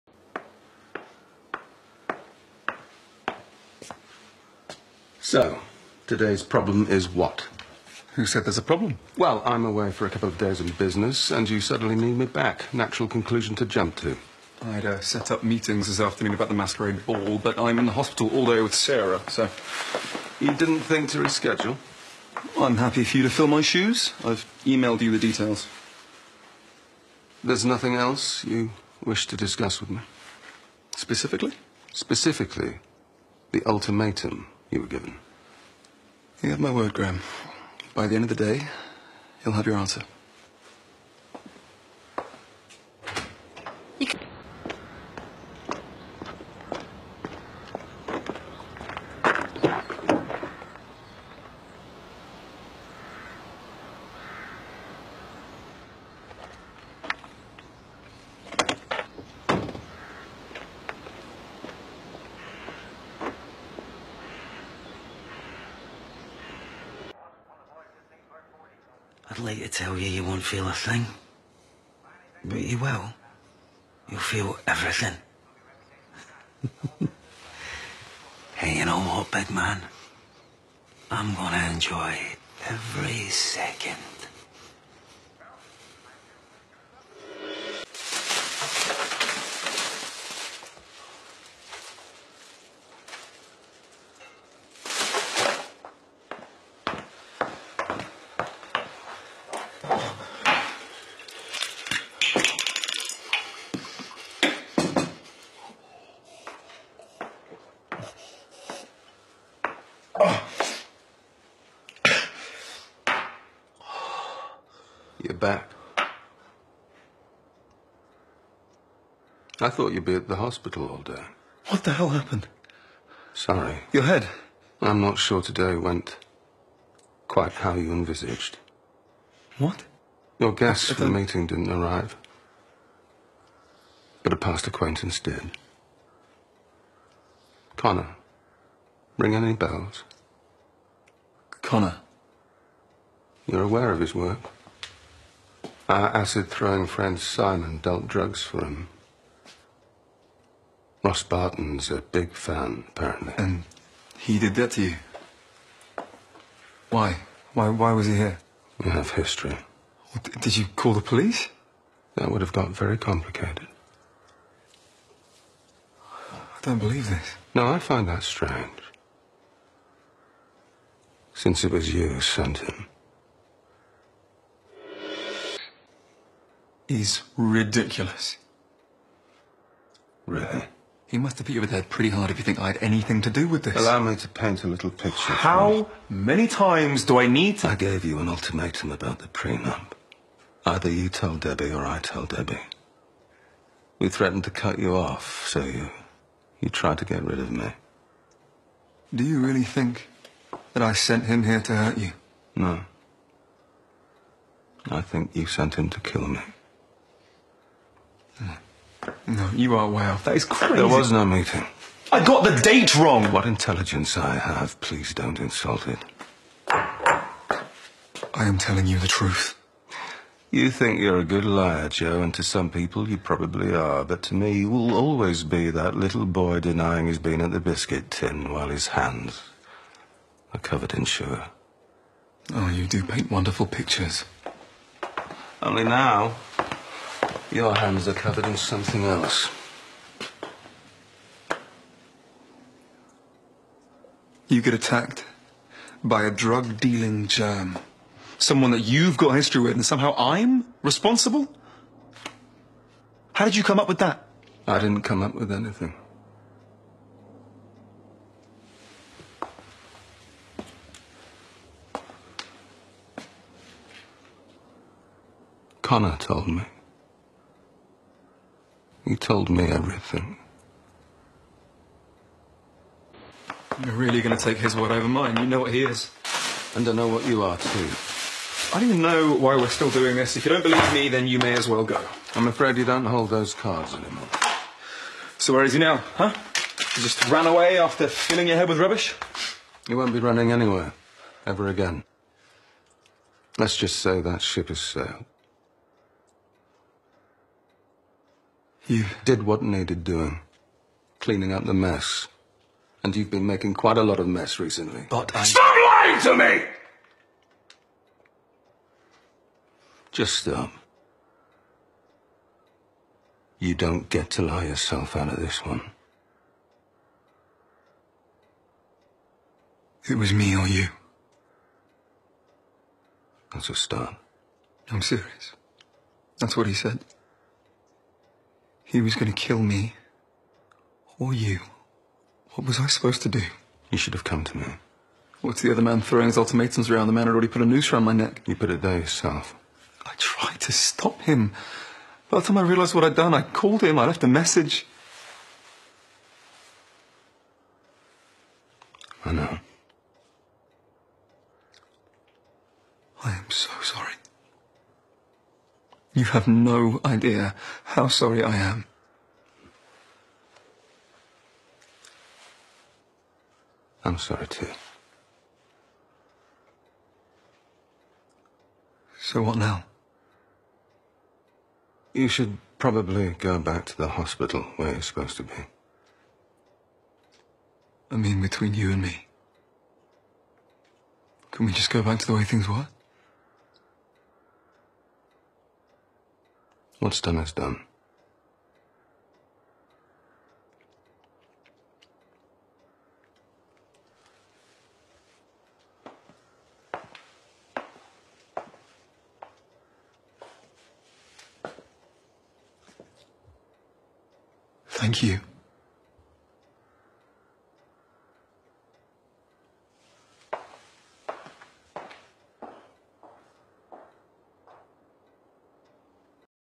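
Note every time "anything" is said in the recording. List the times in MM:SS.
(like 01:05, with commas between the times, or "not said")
03:02, 04:15.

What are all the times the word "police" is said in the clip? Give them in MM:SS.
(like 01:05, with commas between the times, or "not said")
02:41.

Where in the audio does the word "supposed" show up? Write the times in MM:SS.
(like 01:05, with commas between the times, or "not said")
05:32, 06:15.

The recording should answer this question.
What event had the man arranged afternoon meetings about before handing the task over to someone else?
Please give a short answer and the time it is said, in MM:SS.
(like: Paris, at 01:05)
masquerade ball, at 00:16.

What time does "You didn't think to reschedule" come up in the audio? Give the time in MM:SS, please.
00:20.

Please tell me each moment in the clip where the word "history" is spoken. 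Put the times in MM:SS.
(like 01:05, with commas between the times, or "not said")
02:39, 04:09.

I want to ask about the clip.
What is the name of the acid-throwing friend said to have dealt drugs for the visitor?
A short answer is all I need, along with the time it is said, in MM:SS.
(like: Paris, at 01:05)
Simon, at 02:27.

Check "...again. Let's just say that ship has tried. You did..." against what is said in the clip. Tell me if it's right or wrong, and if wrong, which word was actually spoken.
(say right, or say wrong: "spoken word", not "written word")
wrong: "sailed", not "tried".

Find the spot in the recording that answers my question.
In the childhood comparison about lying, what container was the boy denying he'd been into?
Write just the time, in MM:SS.
03:47.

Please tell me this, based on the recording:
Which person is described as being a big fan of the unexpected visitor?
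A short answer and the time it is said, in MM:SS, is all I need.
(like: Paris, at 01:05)
Ross Barton, at 02:31.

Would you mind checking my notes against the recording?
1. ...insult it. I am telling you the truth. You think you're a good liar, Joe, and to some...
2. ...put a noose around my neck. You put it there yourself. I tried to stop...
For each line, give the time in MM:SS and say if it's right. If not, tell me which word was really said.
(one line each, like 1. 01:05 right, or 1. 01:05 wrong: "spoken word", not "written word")
1. 03:35 right
2. 05:37 right.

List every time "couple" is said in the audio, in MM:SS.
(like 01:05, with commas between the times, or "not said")
00:10.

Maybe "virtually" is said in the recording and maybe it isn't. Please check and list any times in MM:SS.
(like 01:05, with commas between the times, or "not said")
not said.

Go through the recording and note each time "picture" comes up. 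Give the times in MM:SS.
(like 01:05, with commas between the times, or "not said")
03:04, 03:53.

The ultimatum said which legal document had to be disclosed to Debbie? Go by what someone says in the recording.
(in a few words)
prenup.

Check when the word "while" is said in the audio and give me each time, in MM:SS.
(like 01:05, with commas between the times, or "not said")
03:48.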